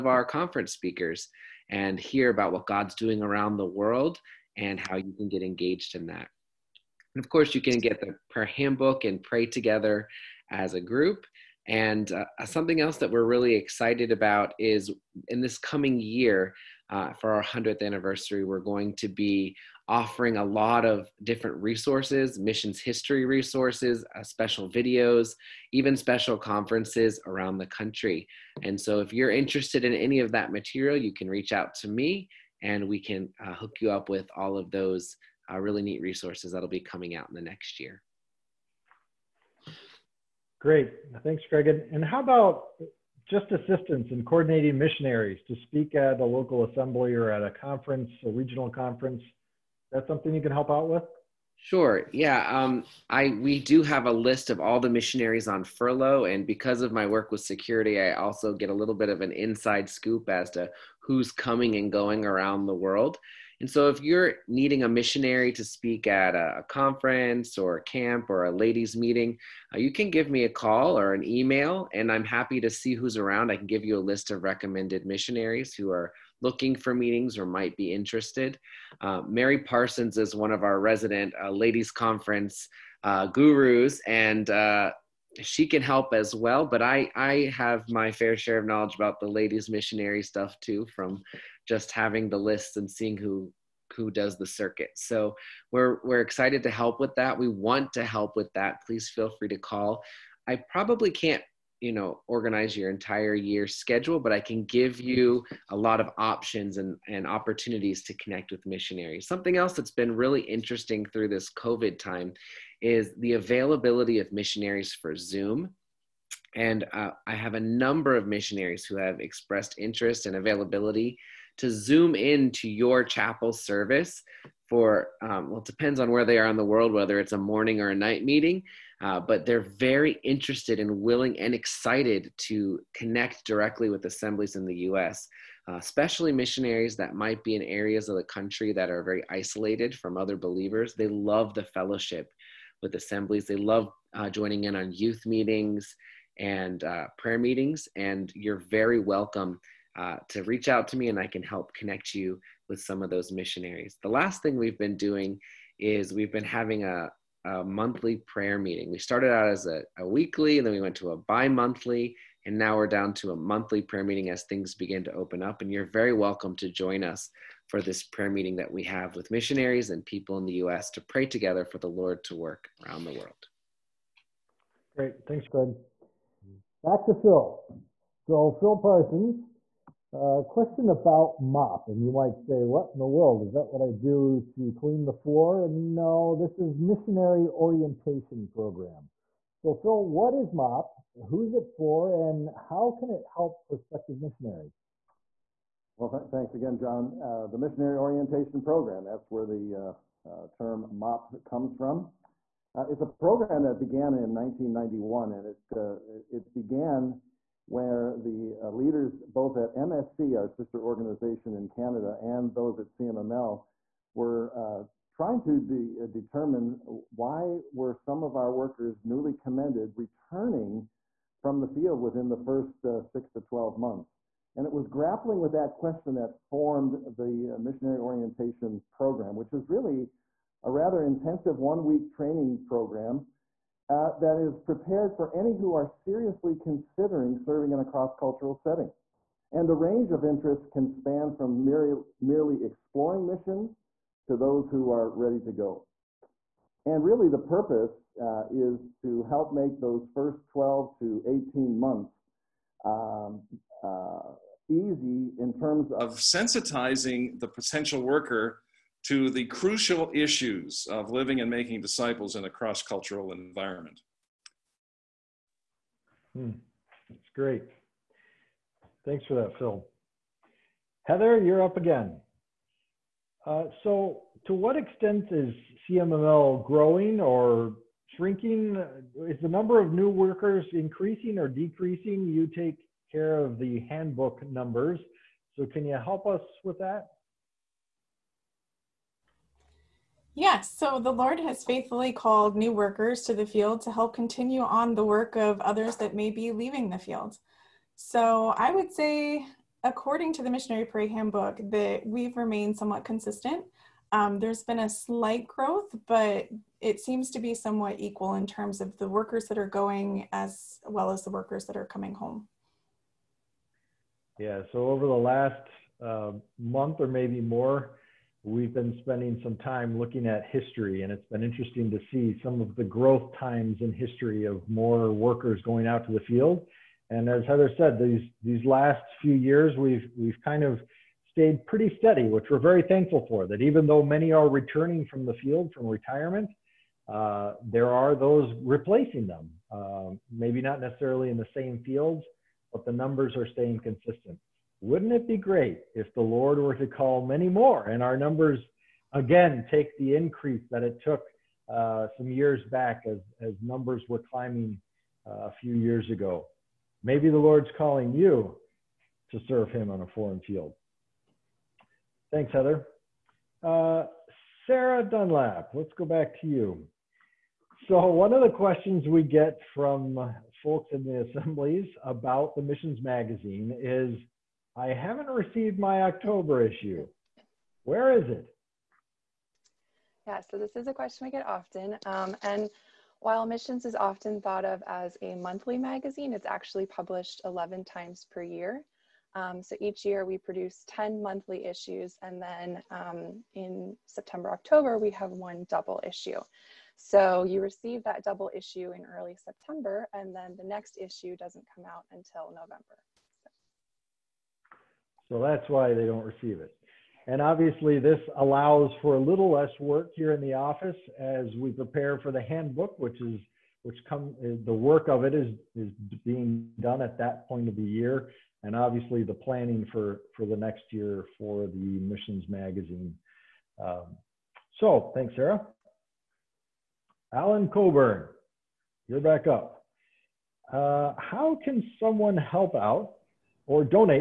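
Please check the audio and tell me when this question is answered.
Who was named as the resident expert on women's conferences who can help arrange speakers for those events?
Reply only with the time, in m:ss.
1:19.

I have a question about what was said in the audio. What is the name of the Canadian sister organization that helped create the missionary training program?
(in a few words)
MSC.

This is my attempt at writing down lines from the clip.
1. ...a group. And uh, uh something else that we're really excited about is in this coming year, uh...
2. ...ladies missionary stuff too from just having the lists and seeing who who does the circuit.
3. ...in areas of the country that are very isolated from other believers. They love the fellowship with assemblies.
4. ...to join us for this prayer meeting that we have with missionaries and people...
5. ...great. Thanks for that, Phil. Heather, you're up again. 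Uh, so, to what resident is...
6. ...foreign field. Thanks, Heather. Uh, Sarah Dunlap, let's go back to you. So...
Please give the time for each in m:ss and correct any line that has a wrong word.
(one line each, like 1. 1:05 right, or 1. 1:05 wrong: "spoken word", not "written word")
1. 0:10 right
2. 1:29 right
3. 2:17 right
4. 2:46 right
5. 4:27 wrong: "extent", not "resident"
6. 6:00 right.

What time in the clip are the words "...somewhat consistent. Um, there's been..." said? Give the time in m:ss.
5:02.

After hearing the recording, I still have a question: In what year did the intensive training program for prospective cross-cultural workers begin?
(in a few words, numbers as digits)
1991.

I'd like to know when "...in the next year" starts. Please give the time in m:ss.
0:37.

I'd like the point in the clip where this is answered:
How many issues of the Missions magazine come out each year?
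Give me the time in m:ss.
6:27.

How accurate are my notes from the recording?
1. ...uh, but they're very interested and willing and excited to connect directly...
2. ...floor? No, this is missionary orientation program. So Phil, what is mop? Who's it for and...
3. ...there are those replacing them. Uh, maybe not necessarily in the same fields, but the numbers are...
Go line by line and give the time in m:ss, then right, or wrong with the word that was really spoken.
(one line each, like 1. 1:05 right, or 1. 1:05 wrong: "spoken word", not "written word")
1. 2:09 right
2. 3:05 right
3. 5:37 right.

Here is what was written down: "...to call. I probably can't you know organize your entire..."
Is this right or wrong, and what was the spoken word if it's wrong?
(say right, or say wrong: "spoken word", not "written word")
right.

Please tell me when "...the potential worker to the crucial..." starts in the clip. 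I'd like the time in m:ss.
4:17.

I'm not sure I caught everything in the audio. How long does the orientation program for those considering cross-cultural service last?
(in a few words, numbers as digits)
One week.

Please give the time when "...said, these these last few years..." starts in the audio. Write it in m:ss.
5:27.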